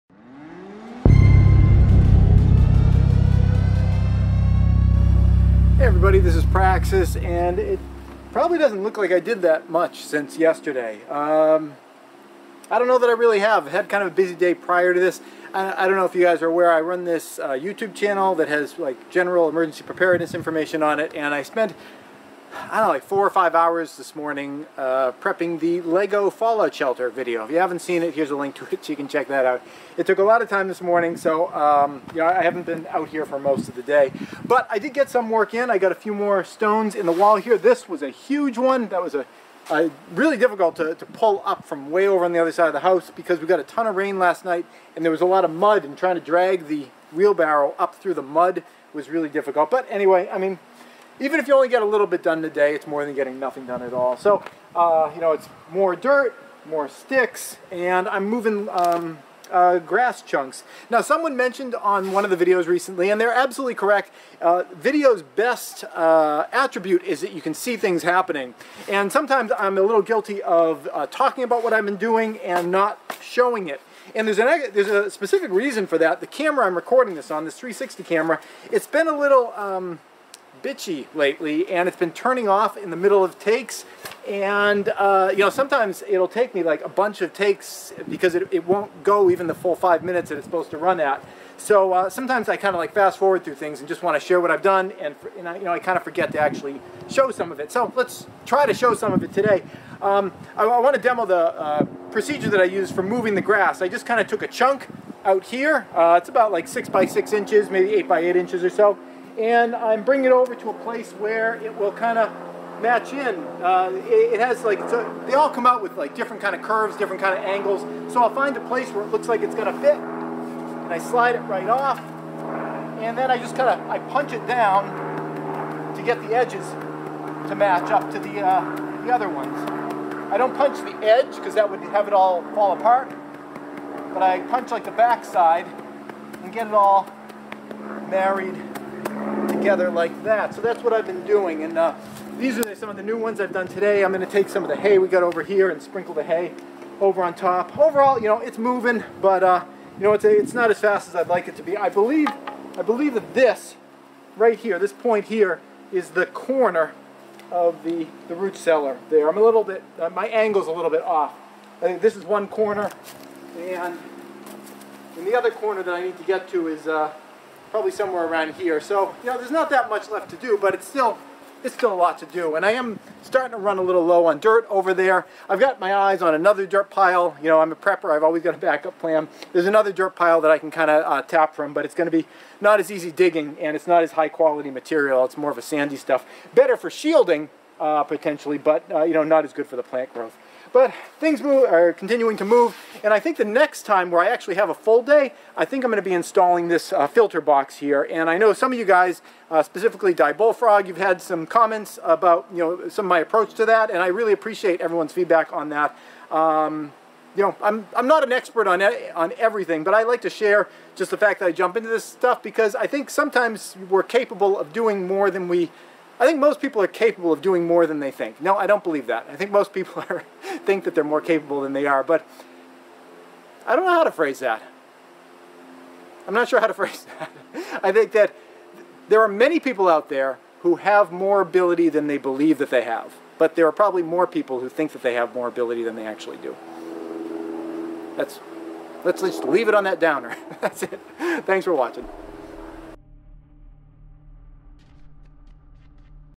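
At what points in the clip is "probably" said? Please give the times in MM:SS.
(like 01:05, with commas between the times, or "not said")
00:08, 02:47, 03:53.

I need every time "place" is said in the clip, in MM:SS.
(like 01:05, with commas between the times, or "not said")
01:50, 01:58.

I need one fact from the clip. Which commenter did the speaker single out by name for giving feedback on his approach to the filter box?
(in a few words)
Die Bullfrog.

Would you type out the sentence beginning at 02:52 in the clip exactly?
And I am starting to run a little low on dirt over there.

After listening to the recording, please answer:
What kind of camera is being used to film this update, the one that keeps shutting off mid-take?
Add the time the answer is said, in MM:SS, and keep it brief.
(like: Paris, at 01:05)
360 camera, at 01:17.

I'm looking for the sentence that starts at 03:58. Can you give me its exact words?
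That's, let's just leave it on that downer.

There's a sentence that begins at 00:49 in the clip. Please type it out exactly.
But anyway, I mean, even if you only get a little bit done today, it's more than getting nothing done at all.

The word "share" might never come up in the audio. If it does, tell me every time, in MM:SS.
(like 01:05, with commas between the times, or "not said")
01:34, 03:30.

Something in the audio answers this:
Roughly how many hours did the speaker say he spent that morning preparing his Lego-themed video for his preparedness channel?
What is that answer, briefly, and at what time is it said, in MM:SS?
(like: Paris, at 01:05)
4 or 5, at 00:23.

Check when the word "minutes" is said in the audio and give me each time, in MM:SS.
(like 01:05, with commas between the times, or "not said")
01:30.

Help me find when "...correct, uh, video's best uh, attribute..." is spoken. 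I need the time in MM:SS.
01:03.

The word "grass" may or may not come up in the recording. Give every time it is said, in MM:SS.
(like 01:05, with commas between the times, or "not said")
00:59, 01:43.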